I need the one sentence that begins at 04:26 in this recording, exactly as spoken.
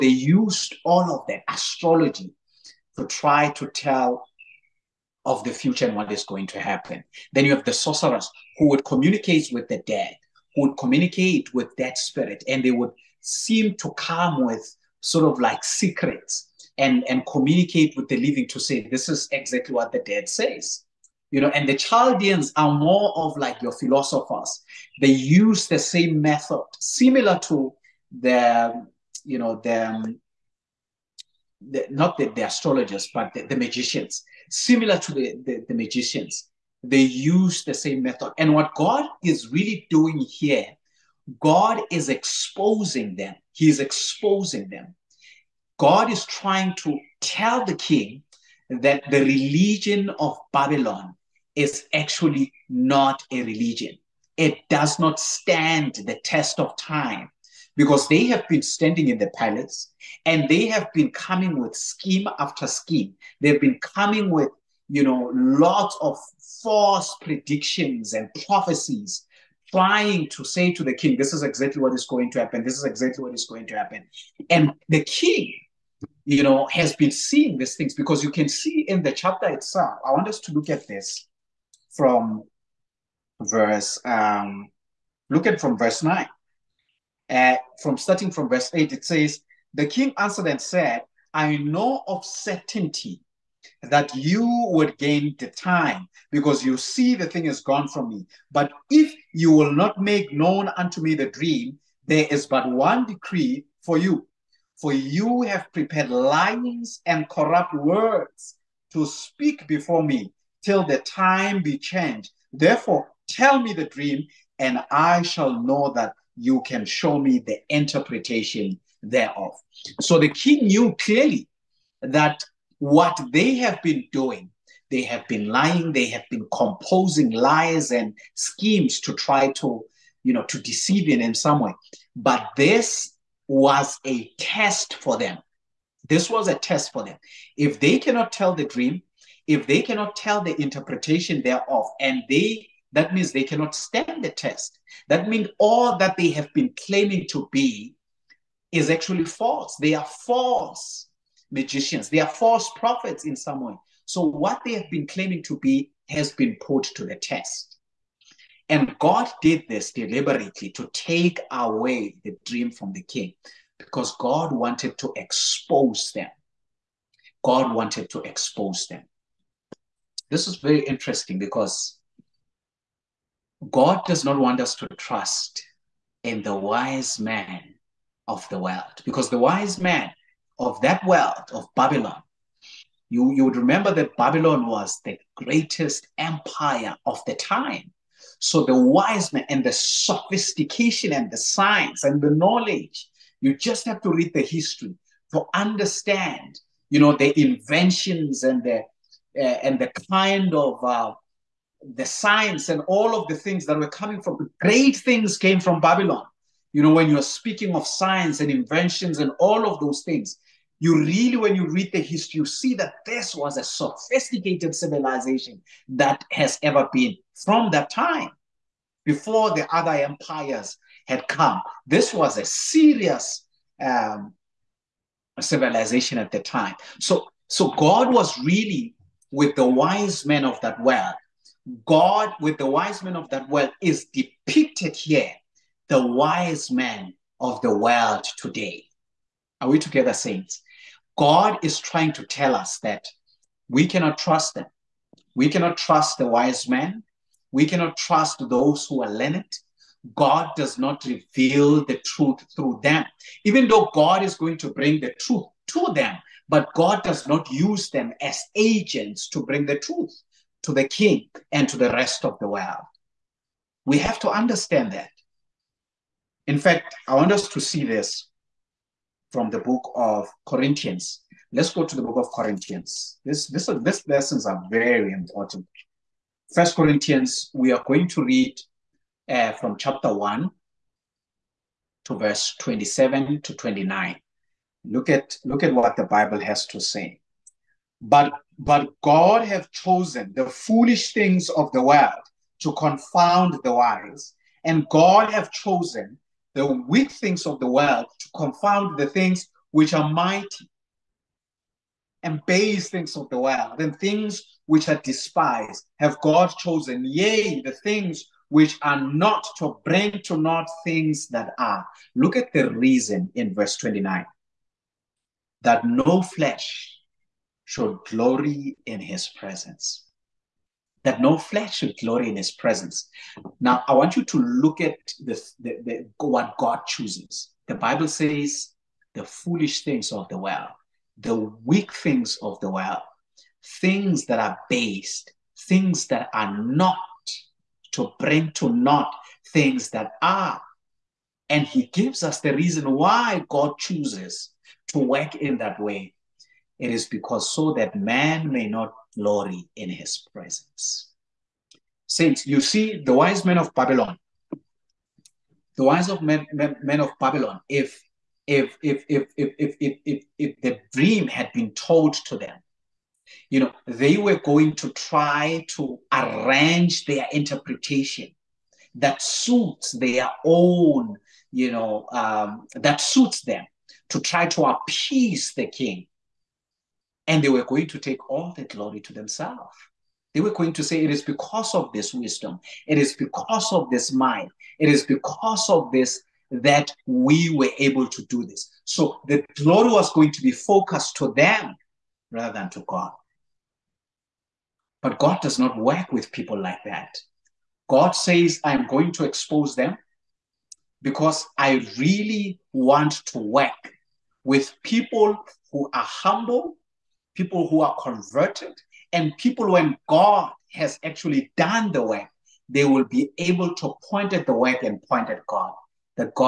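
In fact, I want us to see this from the book of Corinthians.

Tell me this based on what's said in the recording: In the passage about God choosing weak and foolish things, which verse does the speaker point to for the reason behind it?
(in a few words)
Verse 29.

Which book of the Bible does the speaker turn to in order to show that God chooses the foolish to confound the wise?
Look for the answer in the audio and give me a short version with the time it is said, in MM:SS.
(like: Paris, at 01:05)
First Corinthians, at 04:36.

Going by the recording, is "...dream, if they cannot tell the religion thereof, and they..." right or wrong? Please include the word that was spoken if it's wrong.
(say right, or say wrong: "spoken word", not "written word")
wrong: "interpretation", not "religion".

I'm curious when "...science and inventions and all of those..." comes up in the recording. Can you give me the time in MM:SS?
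03:27.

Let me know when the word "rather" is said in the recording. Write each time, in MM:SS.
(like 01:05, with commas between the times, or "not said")
06:32.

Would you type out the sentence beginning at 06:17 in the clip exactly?
And they were going to take all the glory to themselves.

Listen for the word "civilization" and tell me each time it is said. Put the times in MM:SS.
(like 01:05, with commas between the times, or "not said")
03:34, 03:45.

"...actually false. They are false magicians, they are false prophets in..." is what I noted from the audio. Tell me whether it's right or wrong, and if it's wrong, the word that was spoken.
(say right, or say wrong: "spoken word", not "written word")
right.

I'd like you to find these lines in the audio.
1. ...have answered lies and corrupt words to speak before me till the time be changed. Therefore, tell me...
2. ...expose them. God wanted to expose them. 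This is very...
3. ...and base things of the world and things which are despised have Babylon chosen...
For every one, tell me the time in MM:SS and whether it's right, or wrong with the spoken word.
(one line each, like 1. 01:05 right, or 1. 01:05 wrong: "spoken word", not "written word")
1. 01:45 wrong: "prepared", not "answered"
2. 02:45 right
3. 05:02 wrong: "God", not "Babylon".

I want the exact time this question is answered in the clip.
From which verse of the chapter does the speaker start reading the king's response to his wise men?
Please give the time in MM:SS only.
01:28.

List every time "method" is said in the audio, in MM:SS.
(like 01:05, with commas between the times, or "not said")
00:26, 00:38.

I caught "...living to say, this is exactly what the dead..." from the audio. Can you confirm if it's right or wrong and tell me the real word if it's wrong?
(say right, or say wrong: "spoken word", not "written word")
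right.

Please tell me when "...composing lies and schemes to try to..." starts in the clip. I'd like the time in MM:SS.
02:06.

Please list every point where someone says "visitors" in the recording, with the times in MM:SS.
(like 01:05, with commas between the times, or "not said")
not said.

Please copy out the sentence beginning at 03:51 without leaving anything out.
God with the wise men of that world is depicted here, the wise men of the world today.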